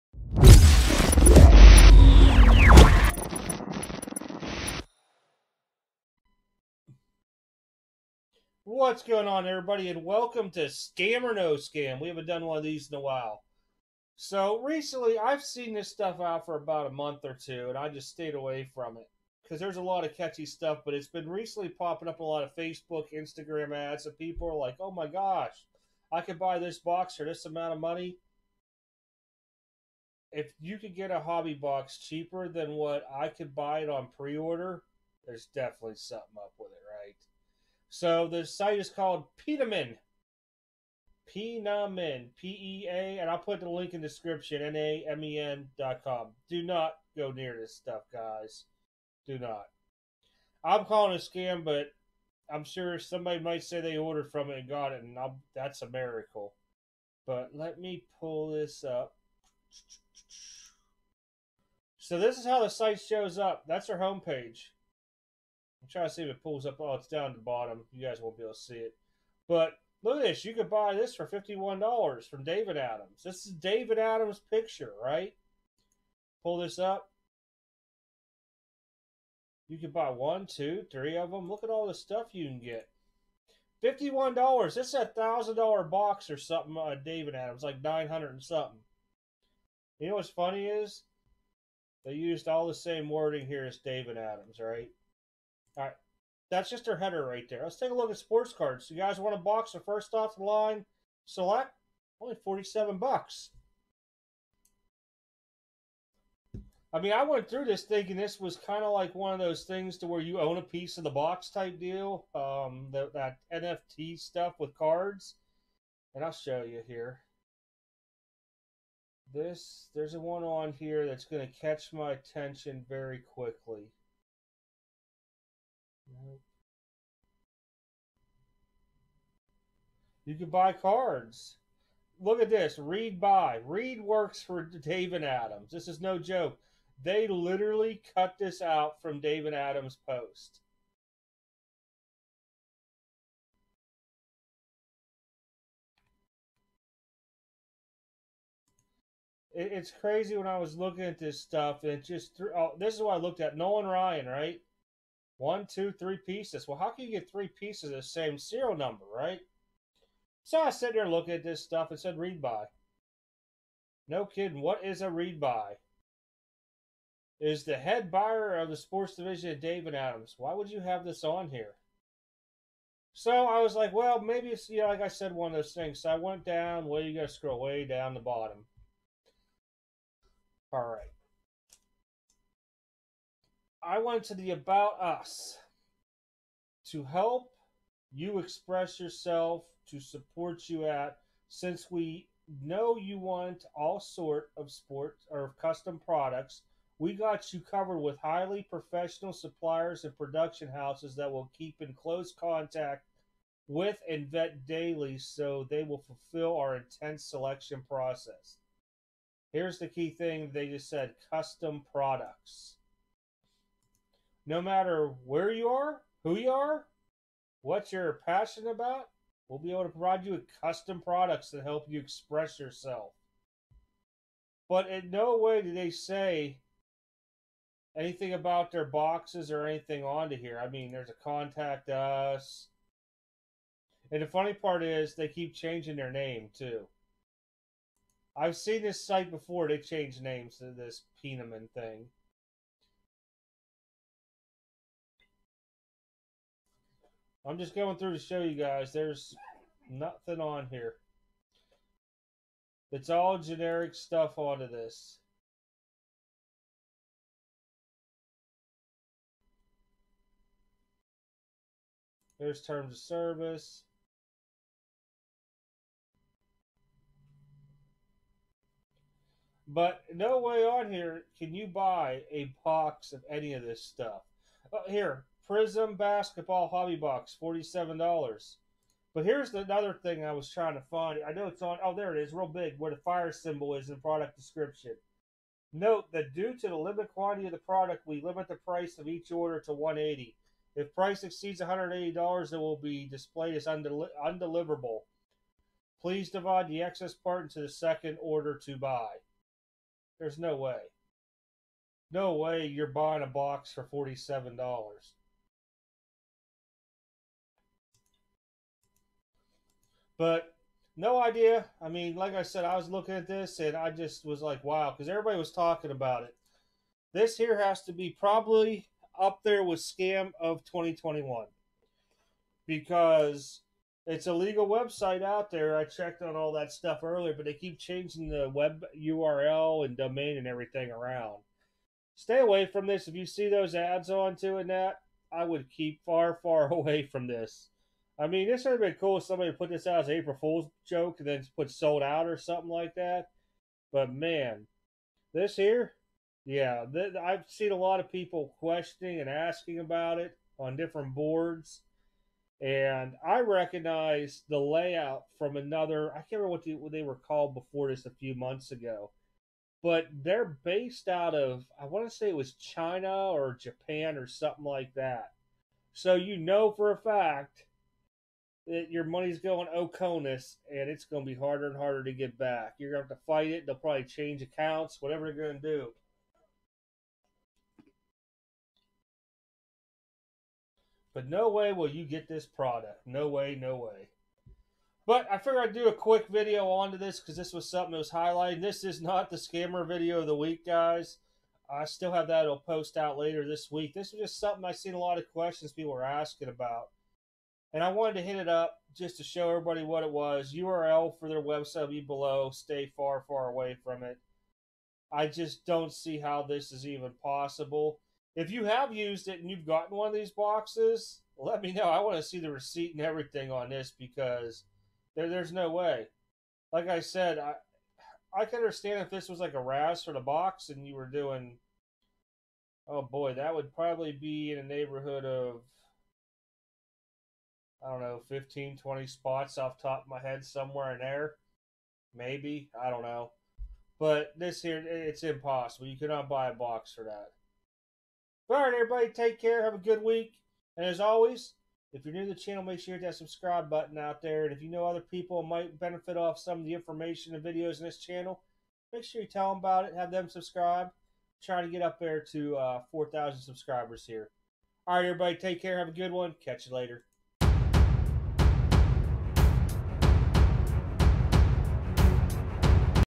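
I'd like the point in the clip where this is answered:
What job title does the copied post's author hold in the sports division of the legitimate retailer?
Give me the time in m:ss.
2:47.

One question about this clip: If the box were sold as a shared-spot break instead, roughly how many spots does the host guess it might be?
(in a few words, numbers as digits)
15 to 20.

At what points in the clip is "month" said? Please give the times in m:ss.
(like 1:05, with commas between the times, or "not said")
0:16, 5:58.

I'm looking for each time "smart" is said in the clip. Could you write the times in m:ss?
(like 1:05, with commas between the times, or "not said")
not said.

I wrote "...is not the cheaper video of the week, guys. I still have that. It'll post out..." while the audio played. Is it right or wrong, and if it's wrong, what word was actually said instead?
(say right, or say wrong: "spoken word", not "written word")
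wrong: "scammer", not "cheaper".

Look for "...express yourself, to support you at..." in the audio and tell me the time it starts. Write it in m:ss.
3:08.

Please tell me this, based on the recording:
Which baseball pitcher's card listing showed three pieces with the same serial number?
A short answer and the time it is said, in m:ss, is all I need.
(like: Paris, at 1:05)
Nolan Ryan, at 2:33.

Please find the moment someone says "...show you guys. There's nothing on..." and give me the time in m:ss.
4:08.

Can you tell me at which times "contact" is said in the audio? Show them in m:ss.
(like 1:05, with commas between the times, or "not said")
3:22, 3:51.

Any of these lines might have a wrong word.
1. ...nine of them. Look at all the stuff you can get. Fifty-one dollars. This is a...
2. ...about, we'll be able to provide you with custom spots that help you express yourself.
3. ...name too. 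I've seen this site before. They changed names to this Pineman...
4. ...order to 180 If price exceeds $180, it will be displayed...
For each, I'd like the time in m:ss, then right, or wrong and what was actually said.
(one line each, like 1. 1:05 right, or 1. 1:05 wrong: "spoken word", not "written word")
1. 1:20 wrong: "three", not "nine"
2. 3:38 wrong: "products", not "spots"
3. 3:56 right
4. 4:49 right.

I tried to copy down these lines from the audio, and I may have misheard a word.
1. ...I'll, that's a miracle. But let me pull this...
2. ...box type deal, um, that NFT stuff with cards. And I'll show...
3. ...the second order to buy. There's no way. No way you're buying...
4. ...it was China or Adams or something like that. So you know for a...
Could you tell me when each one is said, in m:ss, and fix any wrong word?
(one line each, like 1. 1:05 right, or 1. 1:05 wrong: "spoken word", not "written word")
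1. 0:55 right
2. 1:51 right
3. 4:57 right
4. 6:02 wrong: "Japan", not "Adams".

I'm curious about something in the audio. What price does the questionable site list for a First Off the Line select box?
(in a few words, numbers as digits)
$47.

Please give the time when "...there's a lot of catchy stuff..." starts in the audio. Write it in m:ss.
0:19.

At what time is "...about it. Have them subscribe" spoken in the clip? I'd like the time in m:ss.
7:29.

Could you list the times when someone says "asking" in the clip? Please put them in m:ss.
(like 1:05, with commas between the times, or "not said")
5:49, 6:36.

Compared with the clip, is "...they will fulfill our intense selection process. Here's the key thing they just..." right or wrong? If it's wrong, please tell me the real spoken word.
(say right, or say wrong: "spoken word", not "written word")
right.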